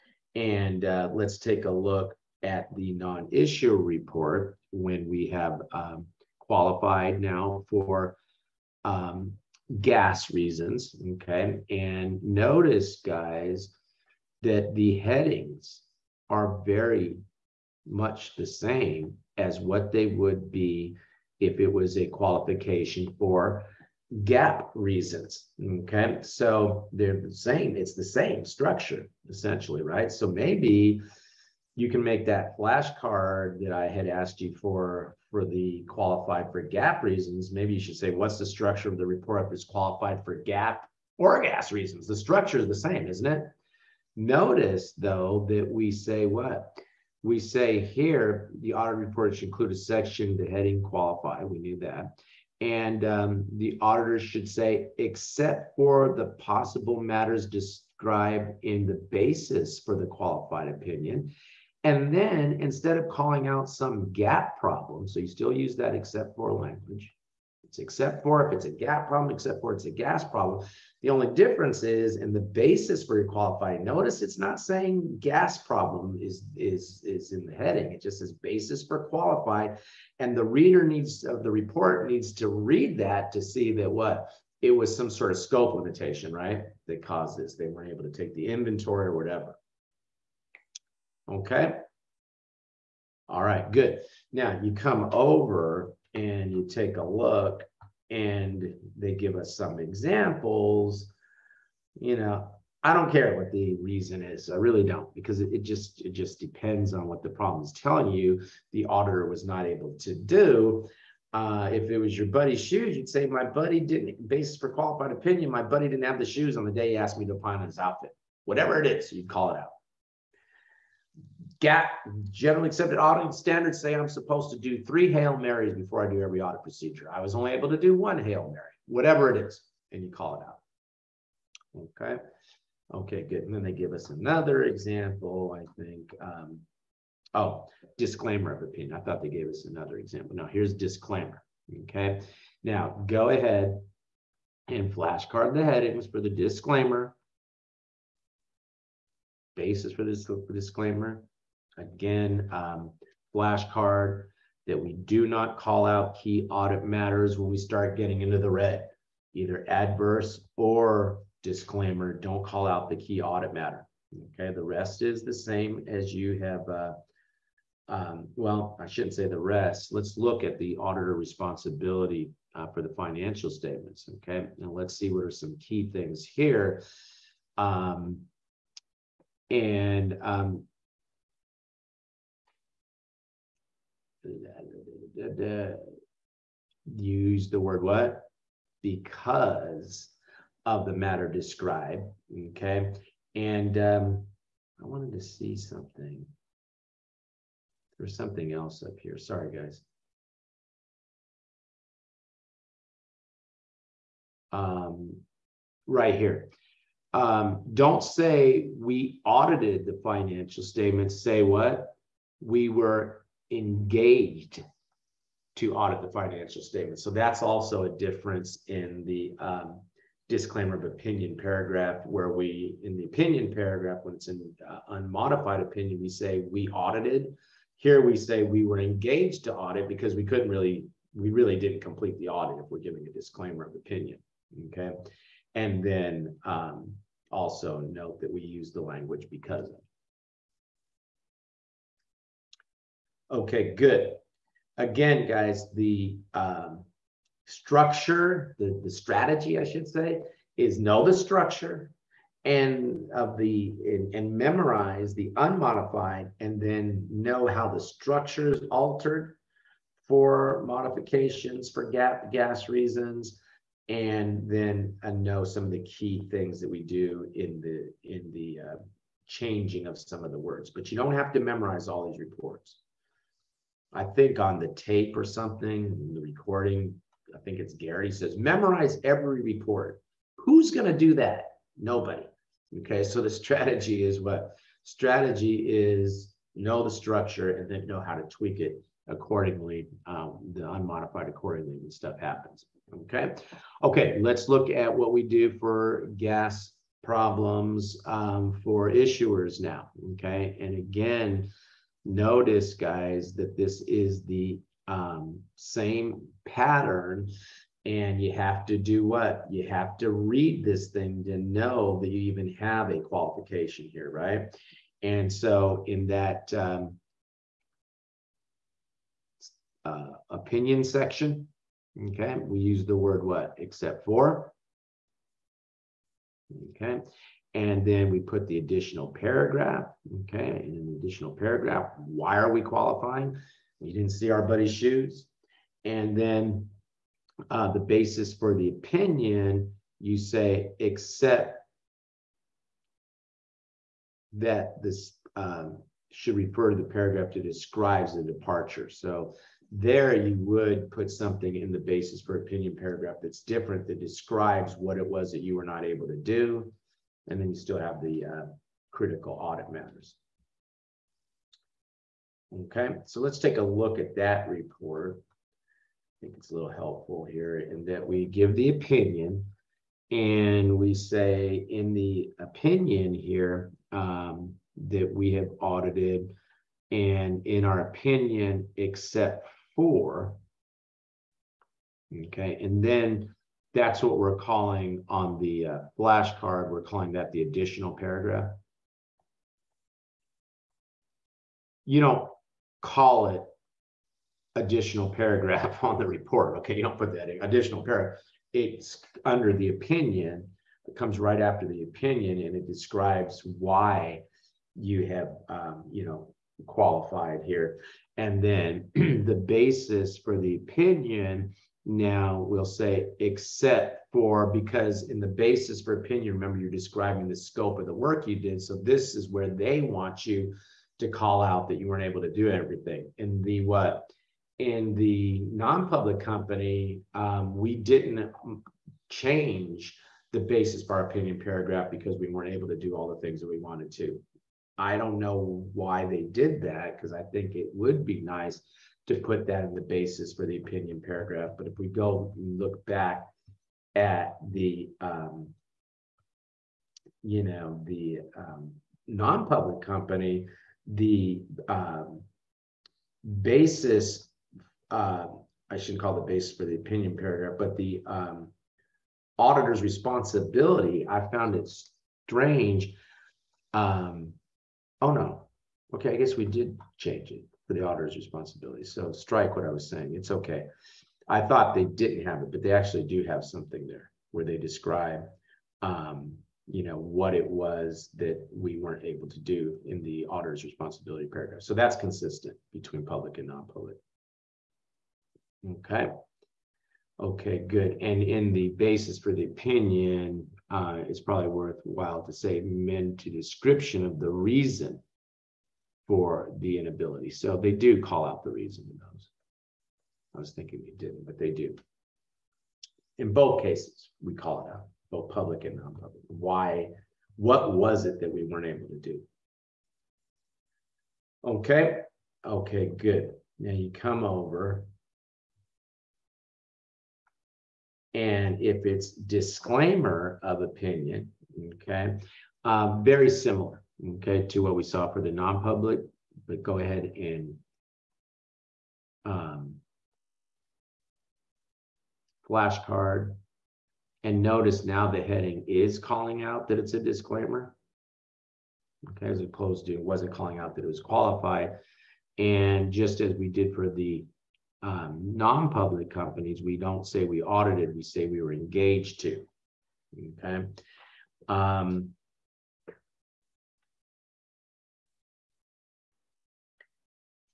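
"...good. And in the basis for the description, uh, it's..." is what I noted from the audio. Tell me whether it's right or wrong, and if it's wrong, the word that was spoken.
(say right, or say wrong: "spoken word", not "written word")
wrong: "opinion", not "description".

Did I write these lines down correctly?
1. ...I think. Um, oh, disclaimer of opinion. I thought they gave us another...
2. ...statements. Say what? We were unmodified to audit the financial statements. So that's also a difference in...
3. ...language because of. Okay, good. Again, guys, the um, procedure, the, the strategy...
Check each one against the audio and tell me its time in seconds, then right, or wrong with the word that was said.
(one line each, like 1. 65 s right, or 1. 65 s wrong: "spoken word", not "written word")
1. 135 s right
2. 210 s wrong: "engaged", not "unmodified"
3. 238 s wrong: "structure", not "procedure".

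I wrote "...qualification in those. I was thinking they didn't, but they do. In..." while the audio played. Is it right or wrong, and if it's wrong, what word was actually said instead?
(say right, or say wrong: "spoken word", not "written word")
wrong: "reason", not "qualification".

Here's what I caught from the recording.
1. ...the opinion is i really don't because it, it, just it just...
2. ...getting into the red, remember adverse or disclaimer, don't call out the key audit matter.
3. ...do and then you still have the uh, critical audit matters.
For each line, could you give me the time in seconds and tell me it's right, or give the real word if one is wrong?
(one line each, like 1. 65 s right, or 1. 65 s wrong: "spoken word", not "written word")
1. 103 s wrong: "reason", not "opinion"
2. 157 s wrong: "either", not "remember"
3. 356 s right.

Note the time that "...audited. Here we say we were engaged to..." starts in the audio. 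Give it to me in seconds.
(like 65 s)
226 s.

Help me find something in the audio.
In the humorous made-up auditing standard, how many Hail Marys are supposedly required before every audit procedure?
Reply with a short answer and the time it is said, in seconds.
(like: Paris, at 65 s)
3, at 124 s.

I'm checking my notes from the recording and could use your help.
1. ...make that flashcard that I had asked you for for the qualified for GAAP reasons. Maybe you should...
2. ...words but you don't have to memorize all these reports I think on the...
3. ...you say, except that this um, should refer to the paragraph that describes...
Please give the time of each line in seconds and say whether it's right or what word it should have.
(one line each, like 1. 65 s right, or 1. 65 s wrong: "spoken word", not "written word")
1. 32 s right
2. 270 s right
3. 339 s right.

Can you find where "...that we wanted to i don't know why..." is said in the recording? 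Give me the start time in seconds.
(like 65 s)
433 s.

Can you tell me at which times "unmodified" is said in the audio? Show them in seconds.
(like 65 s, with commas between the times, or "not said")
224 s, 255 s, 290 s.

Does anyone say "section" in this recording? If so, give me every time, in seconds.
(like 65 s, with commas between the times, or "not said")
49 s, 320 s.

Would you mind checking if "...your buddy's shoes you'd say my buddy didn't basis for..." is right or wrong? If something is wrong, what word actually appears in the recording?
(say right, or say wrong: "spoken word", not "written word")
right.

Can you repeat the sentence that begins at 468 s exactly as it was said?
So strike what I was saying.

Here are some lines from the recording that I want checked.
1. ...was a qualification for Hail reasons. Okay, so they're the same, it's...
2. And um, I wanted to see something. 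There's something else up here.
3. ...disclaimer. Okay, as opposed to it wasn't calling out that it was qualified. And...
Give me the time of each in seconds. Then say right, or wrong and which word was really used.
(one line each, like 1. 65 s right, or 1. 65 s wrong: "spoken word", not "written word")
1. 21 s wrong: "GAAP", not "Hail"
2. 193 s right
3. 536 s right.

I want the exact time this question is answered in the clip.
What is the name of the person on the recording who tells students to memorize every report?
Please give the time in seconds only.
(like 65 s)
277 s.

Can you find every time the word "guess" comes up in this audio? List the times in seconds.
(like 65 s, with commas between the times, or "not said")
466 s.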